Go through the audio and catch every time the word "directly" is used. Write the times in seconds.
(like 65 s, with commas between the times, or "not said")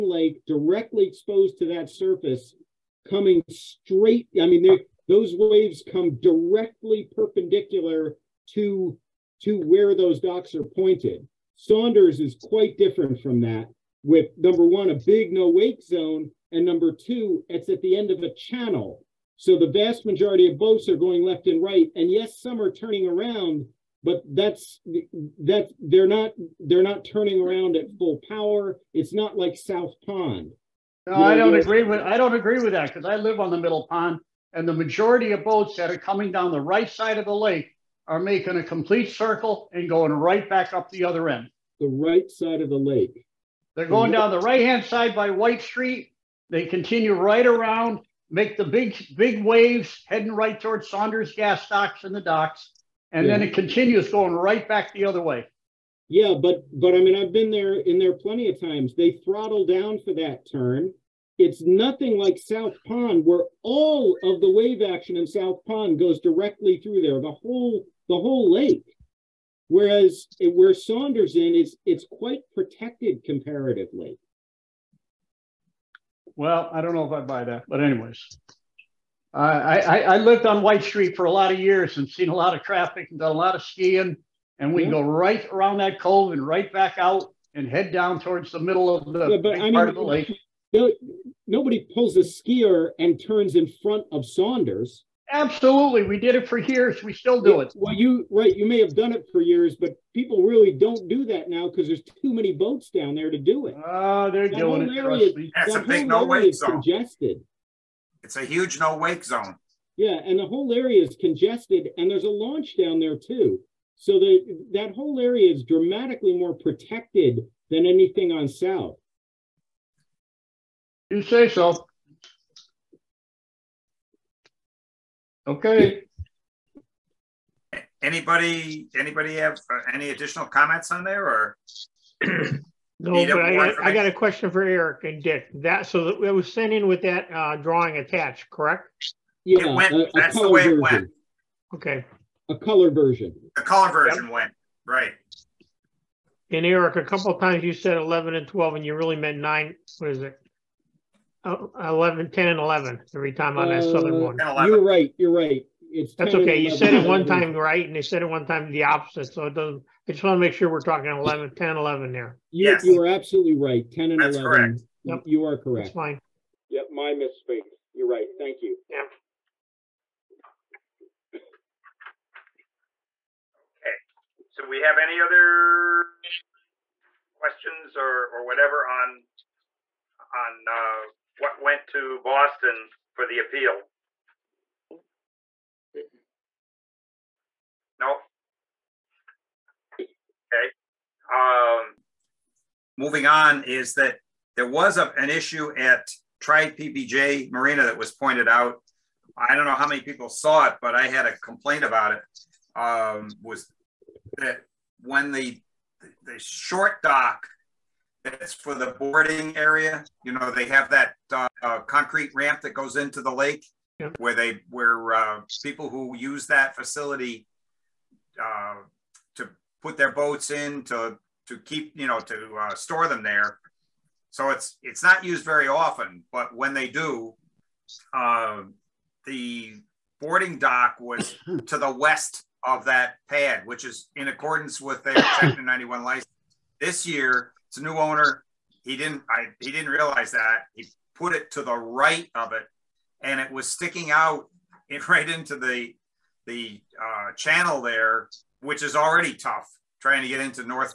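0 s, 6 s, 66 s.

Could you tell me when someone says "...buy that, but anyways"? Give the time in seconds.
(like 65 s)
77 s.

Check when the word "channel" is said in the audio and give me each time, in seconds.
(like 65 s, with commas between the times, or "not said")
18 s, 247 s.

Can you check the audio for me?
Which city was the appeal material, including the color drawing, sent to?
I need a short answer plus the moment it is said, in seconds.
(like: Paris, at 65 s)
Boston, at 182 s.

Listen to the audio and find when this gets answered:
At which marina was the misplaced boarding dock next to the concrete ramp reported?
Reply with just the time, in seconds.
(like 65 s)
196 s.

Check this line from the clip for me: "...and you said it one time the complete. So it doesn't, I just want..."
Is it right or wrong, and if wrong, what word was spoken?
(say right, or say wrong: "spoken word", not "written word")
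wrong: "opposite", not "complete".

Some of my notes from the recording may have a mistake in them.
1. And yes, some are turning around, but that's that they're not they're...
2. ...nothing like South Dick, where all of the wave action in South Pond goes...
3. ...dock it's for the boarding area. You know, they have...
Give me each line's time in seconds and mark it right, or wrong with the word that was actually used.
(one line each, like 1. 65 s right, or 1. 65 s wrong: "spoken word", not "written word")
1. 21 s right
2. 61 s wrong: "Pond", not "Dick"
3. 207 s right.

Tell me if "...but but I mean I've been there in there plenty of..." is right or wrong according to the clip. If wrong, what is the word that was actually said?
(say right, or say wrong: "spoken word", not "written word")
right.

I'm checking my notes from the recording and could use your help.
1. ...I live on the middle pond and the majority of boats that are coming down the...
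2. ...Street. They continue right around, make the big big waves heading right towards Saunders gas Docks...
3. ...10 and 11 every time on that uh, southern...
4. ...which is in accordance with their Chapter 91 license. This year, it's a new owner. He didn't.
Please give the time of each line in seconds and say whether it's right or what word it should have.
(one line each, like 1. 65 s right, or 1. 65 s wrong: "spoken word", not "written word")
1. 33 s right
2. 45 s right
3. 152 s right
4. 233 s right.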